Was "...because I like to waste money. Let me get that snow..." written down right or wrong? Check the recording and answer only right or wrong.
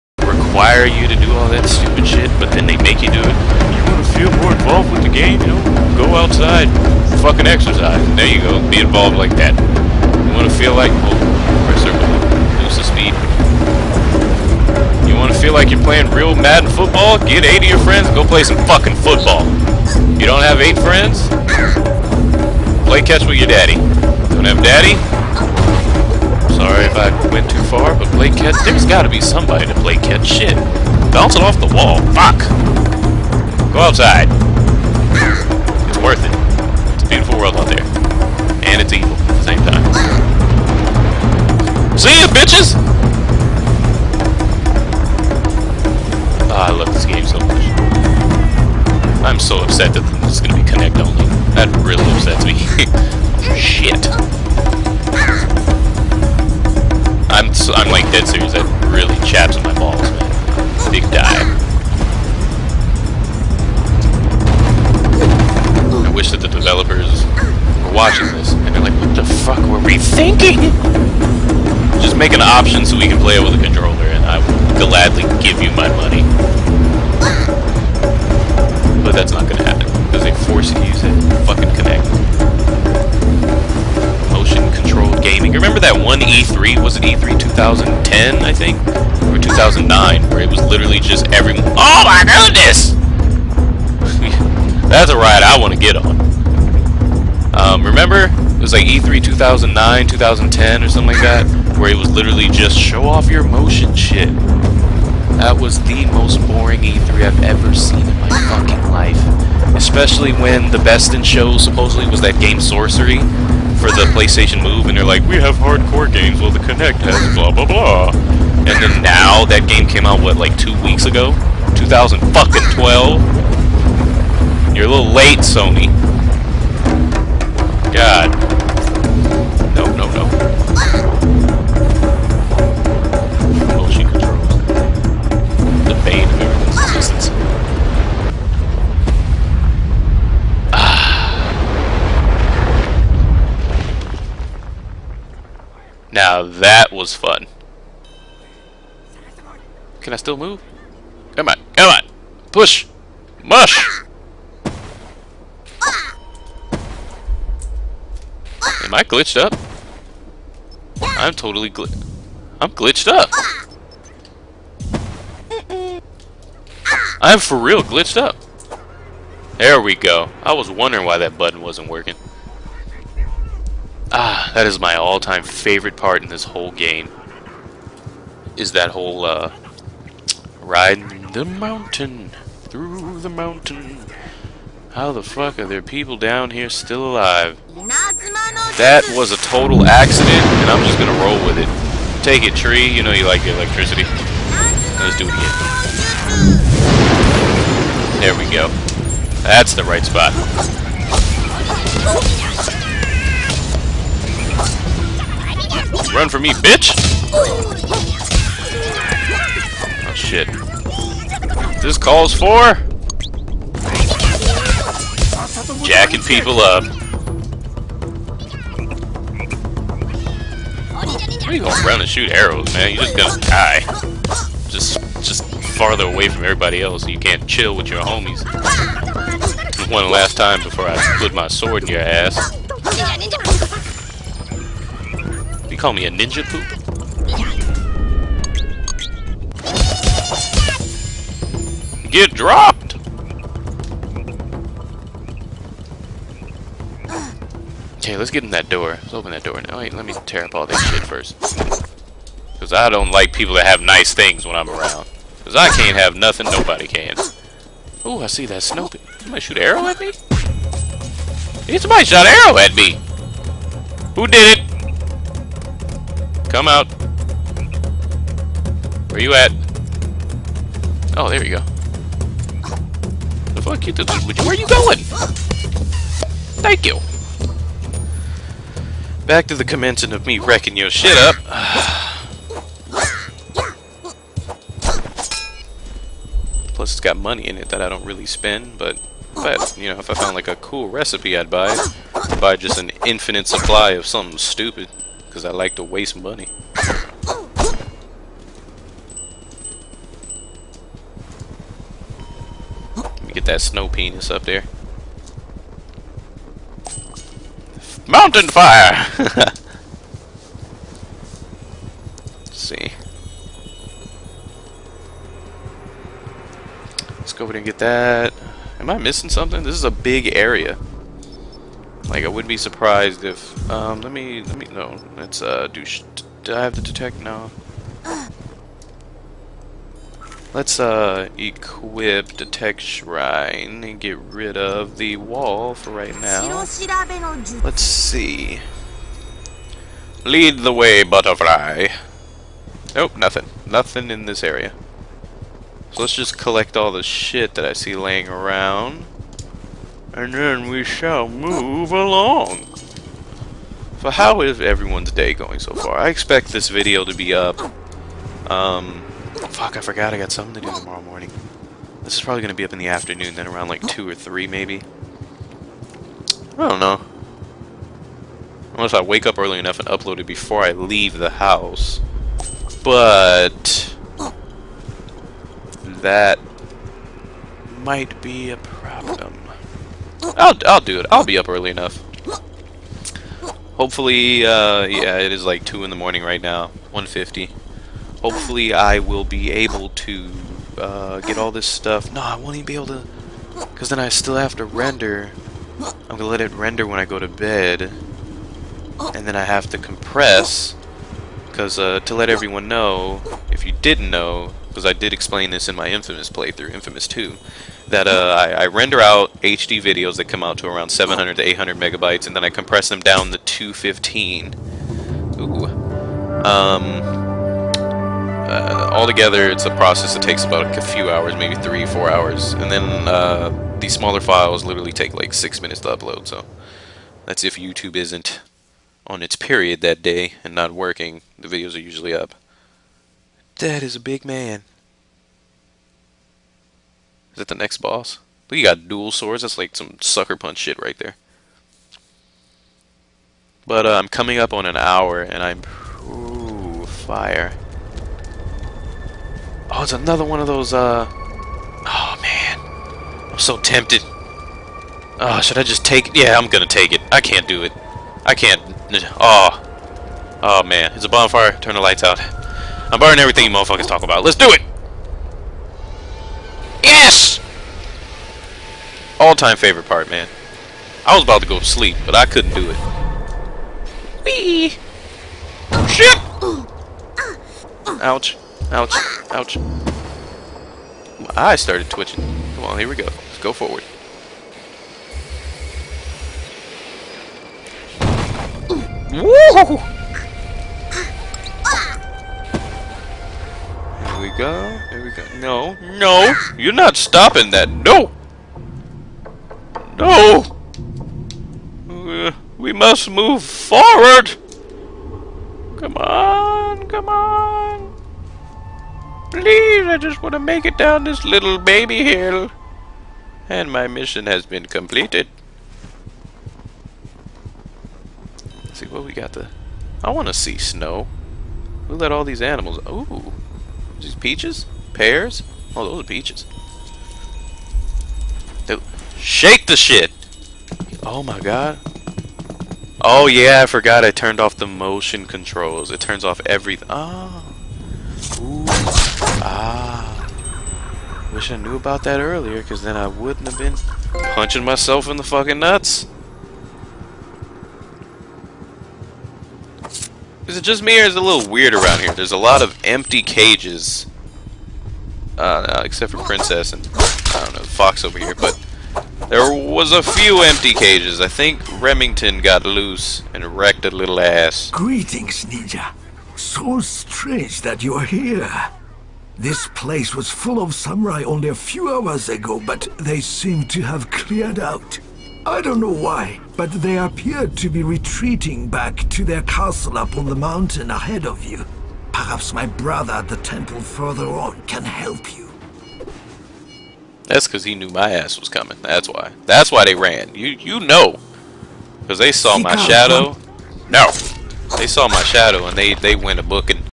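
right.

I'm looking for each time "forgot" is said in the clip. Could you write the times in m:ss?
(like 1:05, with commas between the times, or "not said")
5:59, 8:53.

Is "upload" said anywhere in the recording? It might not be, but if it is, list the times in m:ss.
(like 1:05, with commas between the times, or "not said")
6:09, 7:05.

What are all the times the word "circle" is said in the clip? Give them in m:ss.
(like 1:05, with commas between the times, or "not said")
0:11.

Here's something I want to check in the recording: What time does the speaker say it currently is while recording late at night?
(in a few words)
1:50.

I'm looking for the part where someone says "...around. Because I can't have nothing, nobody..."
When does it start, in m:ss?
4:14.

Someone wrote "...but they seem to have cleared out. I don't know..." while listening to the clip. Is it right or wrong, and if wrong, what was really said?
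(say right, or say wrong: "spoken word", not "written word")
right.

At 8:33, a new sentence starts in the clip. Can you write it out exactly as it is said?
And my mission has been completed.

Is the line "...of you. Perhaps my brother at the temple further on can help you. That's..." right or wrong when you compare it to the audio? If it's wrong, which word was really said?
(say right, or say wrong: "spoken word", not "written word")
right.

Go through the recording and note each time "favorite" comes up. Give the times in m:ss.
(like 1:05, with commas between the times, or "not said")
2:55, 7:49.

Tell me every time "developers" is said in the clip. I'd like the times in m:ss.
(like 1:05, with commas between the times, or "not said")
1:06.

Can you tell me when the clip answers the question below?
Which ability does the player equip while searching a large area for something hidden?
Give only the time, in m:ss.
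5:32.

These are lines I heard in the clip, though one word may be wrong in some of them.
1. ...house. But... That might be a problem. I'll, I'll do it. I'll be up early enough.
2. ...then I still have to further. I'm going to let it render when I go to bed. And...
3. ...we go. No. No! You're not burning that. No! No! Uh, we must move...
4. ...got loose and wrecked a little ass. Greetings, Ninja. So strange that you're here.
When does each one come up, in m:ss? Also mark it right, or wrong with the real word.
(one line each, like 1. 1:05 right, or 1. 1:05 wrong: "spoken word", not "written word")
1. 6:11 right
2. 6:33 wrong: "render", not "further"
3. 8:15 wrong: "stopping", not "burning"
4. 9:22 right.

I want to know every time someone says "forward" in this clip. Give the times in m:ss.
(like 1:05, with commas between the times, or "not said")
8:03, 8:23.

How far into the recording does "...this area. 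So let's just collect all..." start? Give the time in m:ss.
5:44.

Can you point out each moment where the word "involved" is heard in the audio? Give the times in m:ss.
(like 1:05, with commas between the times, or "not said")
0:04, 0:08.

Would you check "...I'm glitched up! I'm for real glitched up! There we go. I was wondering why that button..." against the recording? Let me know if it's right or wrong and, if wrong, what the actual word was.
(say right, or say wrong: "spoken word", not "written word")
right.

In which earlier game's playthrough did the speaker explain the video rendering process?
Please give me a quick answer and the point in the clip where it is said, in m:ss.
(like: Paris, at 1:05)
Infamous 2, at 6:46.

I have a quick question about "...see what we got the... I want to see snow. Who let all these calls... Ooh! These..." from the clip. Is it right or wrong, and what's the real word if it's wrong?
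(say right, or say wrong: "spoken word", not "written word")
wrong: "animals", not "calls".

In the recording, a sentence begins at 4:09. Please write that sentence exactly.
Wait, let me tear up all this shit first.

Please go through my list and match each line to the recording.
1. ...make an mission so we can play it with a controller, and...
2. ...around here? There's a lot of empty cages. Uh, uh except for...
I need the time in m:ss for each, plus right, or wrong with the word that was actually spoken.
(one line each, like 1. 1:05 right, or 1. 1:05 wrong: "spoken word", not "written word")
1. 1:12 wrong: "option", not "mission"
2. 9:11 right.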